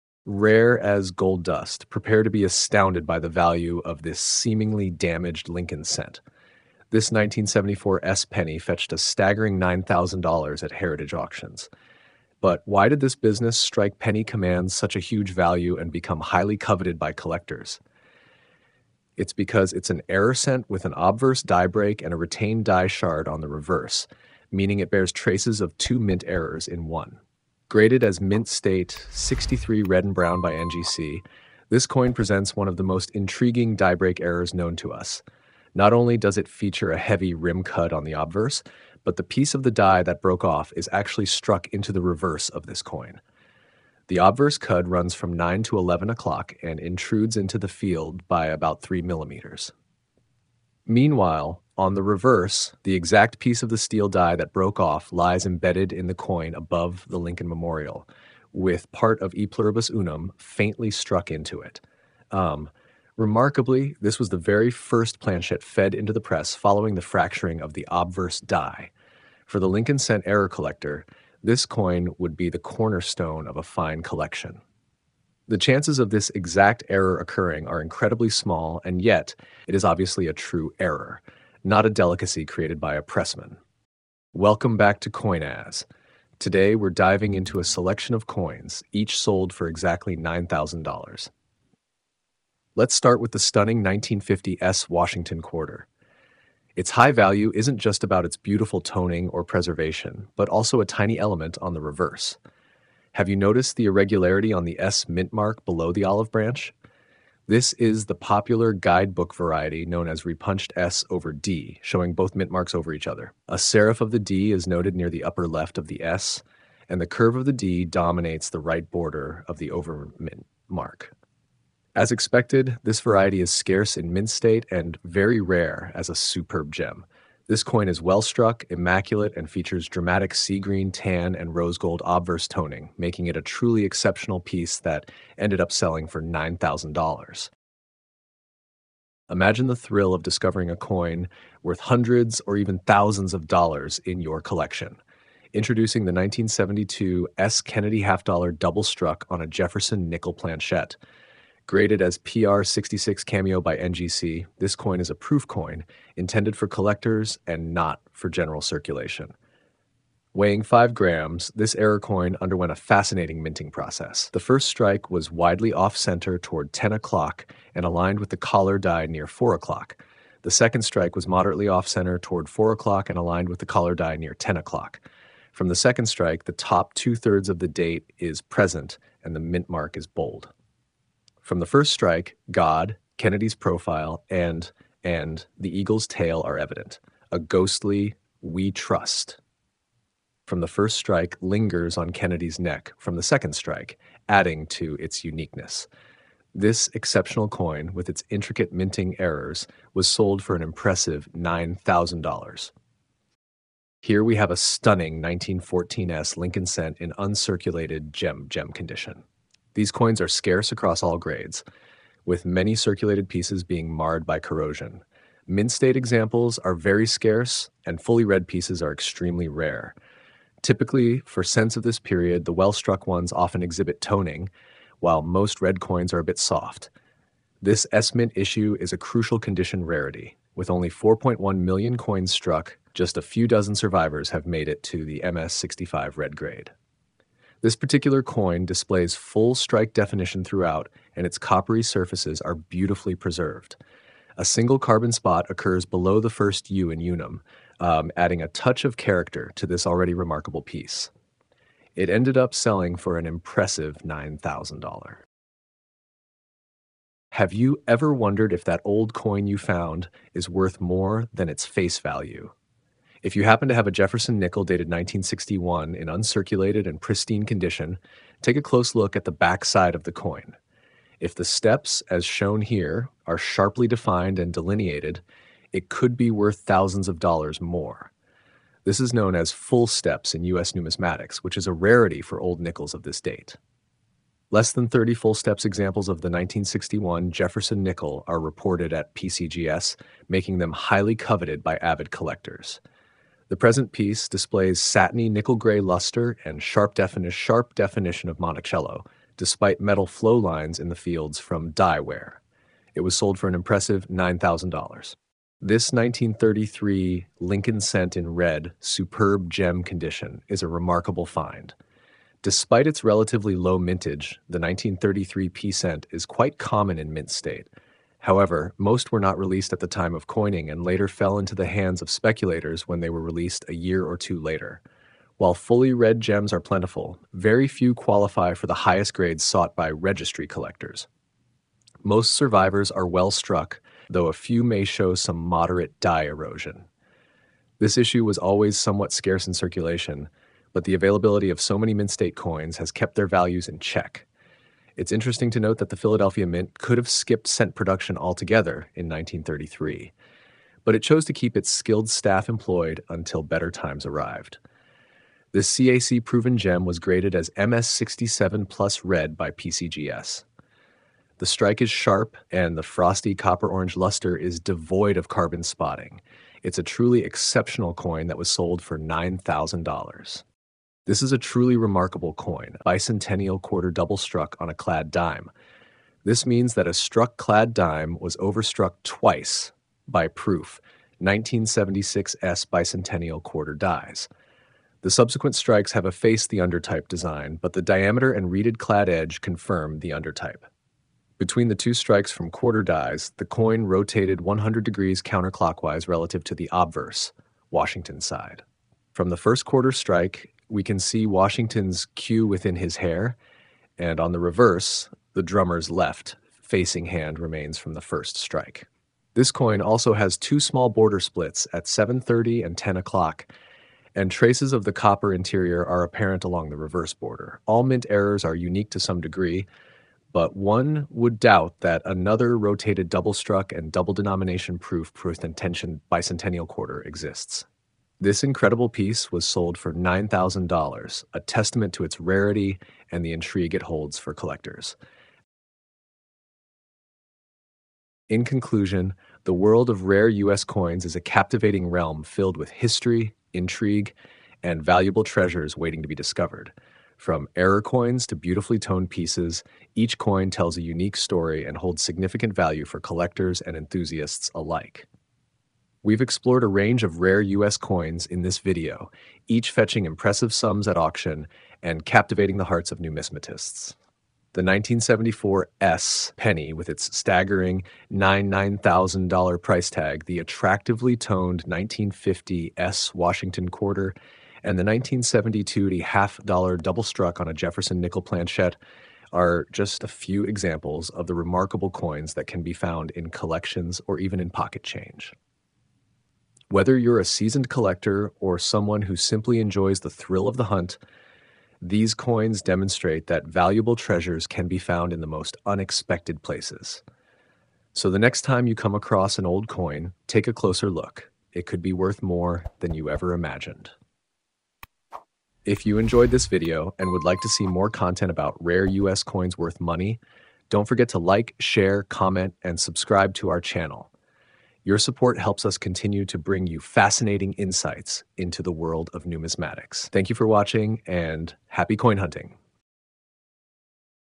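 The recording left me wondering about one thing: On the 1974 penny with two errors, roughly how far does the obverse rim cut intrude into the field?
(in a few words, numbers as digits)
3 millimeters.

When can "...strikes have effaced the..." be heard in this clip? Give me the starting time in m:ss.
6:25.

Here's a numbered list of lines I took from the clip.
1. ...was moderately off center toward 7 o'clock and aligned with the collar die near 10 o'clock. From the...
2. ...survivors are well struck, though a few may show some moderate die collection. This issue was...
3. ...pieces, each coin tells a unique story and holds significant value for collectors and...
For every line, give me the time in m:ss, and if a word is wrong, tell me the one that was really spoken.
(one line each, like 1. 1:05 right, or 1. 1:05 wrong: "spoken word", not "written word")
1. 2:51 wrong: "4", not "7"
2. 5:32 wrong: "erosion", not "collection"
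3. 7:29 right.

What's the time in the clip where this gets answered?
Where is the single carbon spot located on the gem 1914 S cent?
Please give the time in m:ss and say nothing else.
4:05.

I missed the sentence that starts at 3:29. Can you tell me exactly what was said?
These coins are scarce across all grades, with many circulated pieces being marred by corrosion.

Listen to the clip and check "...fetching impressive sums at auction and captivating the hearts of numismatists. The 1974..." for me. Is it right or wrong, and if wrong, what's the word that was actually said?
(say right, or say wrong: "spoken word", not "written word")
right.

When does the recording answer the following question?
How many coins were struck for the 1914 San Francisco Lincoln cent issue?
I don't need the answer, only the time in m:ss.
3:50.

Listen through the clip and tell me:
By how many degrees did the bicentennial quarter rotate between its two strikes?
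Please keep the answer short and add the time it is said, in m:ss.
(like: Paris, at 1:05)
100 degrees, at 6:34.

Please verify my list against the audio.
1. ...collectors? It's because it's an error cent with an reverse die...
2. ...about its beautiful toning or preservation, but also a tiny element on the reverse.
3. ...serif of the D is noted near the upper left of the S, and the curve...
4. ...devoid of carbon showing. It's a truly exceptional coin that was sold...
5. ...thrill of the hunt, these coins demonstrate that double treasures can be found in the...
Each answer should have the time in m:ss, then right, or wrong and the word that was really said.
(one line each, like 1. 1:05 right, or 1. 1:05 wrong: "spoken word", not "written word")
1. 0:17 wrong: "obverse", not "reverse"
2. 1:38 right
3. 1:53 right
4. 6:04 wrong: "spotting", not "showing"
5. 8:10 wrong: "valuable", not "double".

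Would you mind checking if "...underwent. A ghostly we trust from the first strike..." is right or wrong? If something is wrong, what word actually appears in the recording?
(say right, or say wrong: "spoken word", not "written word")
wrong: "evident", not "underwent".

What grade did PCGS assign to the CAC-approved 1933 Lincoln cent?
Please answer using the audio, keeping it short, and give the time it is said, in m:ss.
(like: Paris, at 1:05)
MS67+ red, at 5:57.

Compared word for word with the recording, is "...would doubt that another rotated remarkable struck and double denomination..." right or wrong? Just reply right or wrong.
wrong.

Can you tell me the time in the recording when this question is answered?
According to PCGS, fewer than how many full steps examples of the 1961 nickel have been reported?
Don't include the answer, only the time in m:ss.
4:44.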